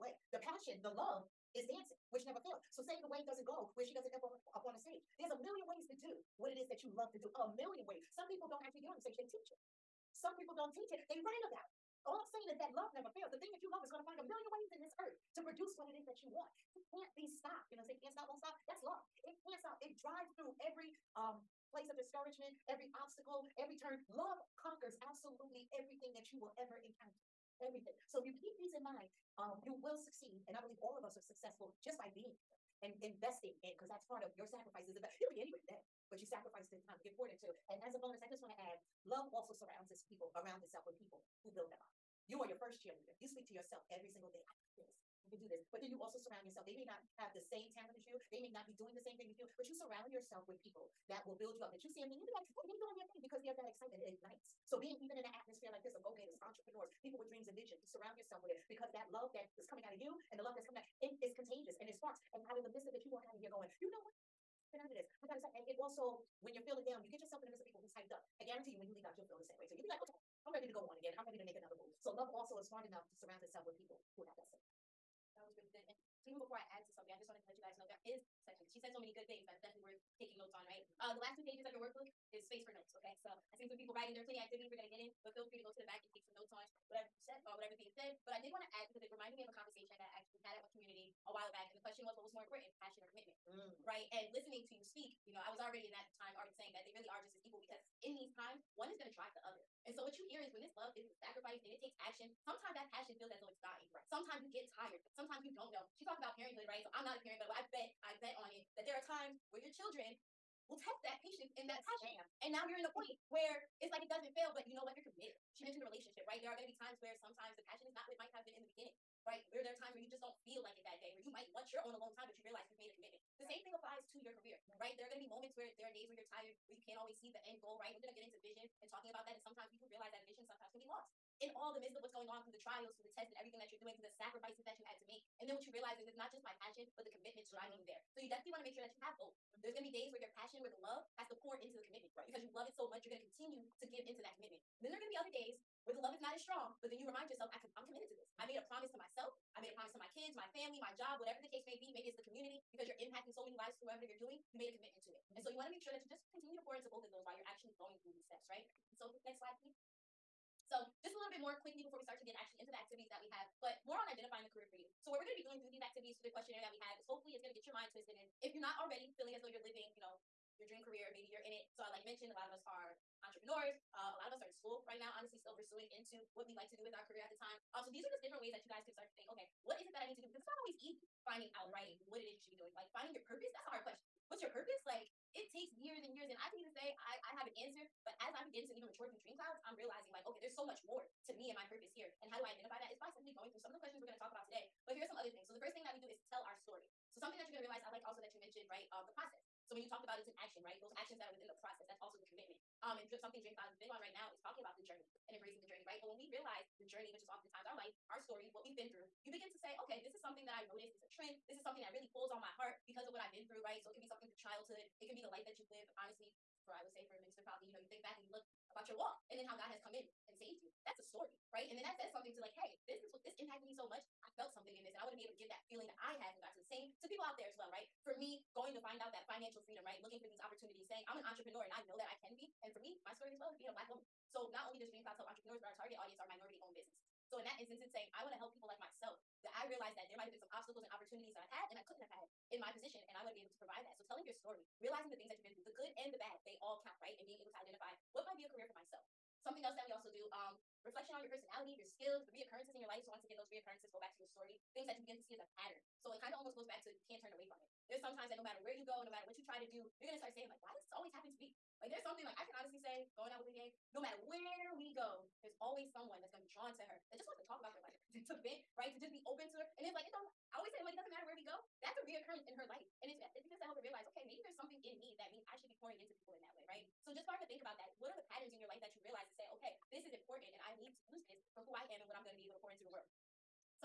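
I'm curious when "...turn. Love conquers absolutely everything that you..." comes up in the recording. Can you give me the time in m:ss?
0:23.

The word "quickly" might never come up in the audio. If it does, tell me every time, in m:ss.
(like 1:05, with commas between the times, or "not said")
2:41.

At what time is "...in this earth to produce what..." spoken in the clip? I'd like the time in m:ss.
0:14.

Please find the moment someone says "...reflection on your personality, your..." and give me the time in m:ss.
4:10.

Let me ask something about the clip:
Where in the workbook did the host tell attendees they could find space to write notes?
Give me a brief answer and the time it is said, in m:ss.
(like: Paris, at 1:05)
last two pages, at 1:21.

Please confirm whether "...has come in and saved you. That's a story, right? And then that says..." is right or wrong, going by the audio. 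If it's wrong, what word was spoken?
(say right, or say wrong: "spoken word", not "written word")
right.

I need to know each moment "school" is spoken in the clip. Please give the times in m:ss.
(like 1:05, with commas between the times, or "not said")
2:54.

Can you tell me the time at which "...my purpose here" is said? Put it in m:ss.
3:11.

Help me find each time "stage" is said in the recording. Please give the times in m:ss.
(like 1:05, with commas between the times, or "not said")
0:04, 0:08.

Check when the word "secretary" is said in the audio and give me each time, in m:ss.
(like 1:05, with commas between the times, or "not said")
not said.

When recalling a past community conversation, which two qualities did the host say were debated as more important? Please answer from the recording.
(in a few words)
passion or commitment.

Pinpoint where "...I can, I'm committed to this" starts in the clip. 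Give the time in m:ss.
2:27.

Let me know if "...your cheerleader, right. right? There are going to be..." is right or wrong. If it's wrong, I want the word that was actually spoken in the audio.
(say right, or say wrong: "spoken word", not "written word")
wrong: "career", not "cheerleader".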